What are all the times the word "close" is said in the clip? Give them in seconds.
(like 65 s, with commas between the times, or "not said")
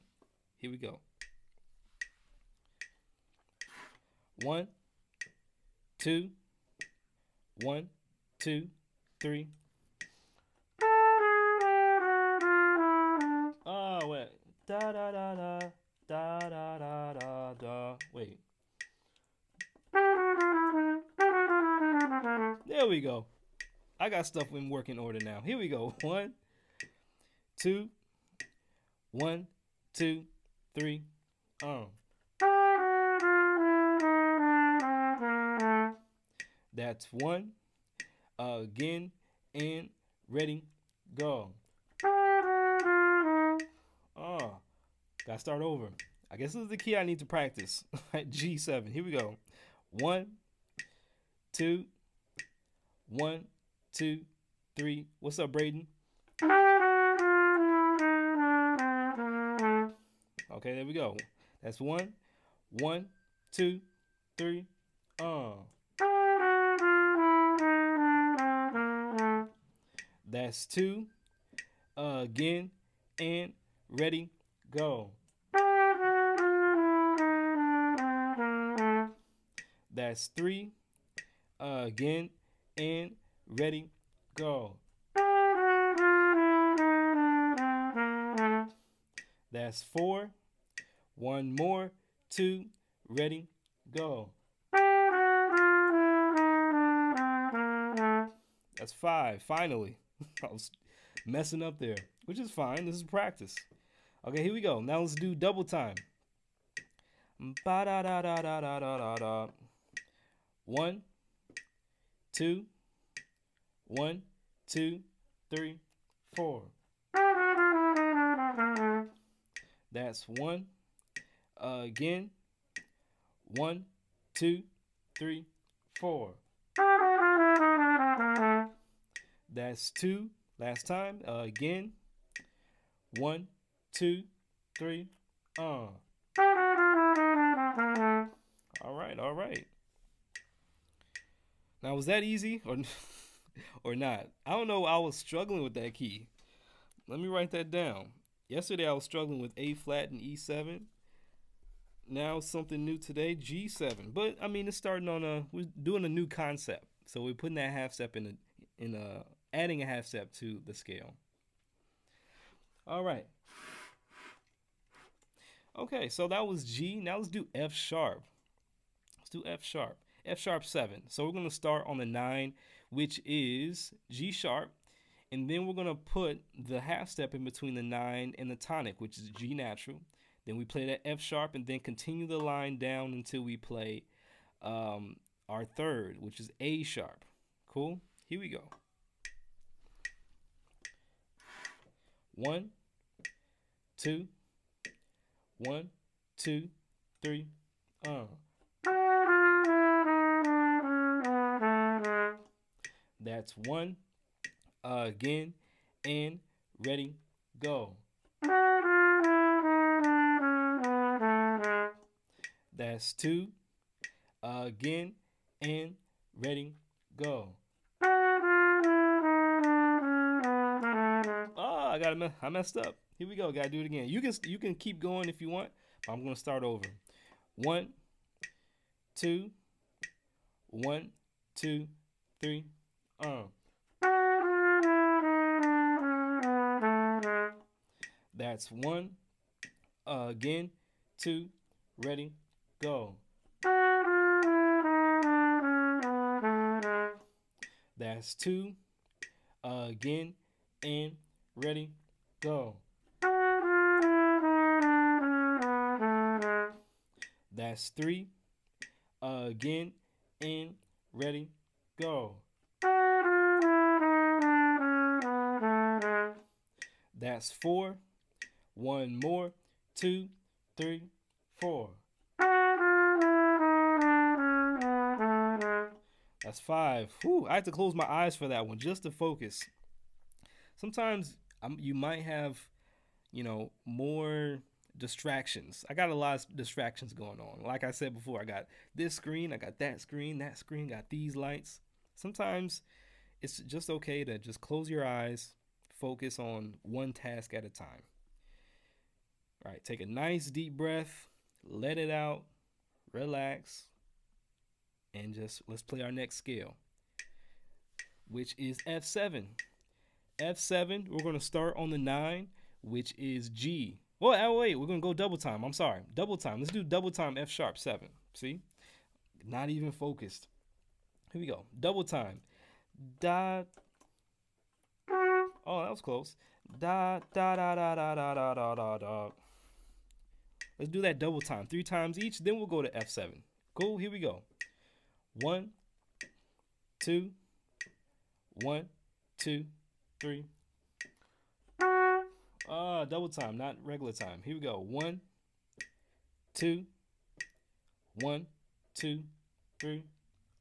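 277 s, 294 s, 326 s.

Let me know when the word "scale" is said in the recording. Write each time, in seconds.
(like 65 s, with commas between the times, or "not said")
160 s, 306 s.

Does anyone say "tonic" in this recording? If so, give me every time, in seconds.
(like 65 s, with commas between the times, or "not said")
178 s.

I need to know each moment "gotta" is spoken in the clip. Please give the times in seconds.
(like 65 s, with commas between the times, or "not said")
45 s, 223 s.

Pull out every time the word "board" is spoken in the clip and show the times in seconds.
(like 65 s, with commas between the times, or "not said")
not said.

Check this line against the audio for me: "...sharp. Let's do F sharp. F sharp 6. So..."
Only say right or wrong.
wrong.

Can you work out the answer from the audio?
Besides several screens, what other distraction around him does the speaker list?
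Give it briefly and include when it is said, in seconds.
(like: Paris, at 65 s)
Lights, at 291 s.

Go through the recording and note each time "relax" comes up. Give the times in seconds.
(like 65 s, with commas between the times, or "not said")
303 s.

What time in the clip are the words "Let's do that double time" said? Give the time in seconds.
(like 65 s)
330 s.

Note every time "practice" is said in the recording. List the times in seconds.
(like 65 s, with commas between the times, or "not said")
47 s, 103 s.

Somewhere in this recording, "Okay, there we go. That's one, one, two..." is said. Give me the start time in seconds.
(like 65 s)
60 s.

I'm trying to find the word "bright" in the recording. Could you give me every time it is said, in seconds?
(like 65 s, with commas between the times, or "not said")
not said.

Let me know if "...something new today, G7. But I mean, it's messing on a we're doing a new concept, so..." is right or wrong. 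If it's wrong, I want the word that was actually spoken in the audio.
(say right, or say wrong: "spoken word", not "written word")
wrong: "starting", not "messing".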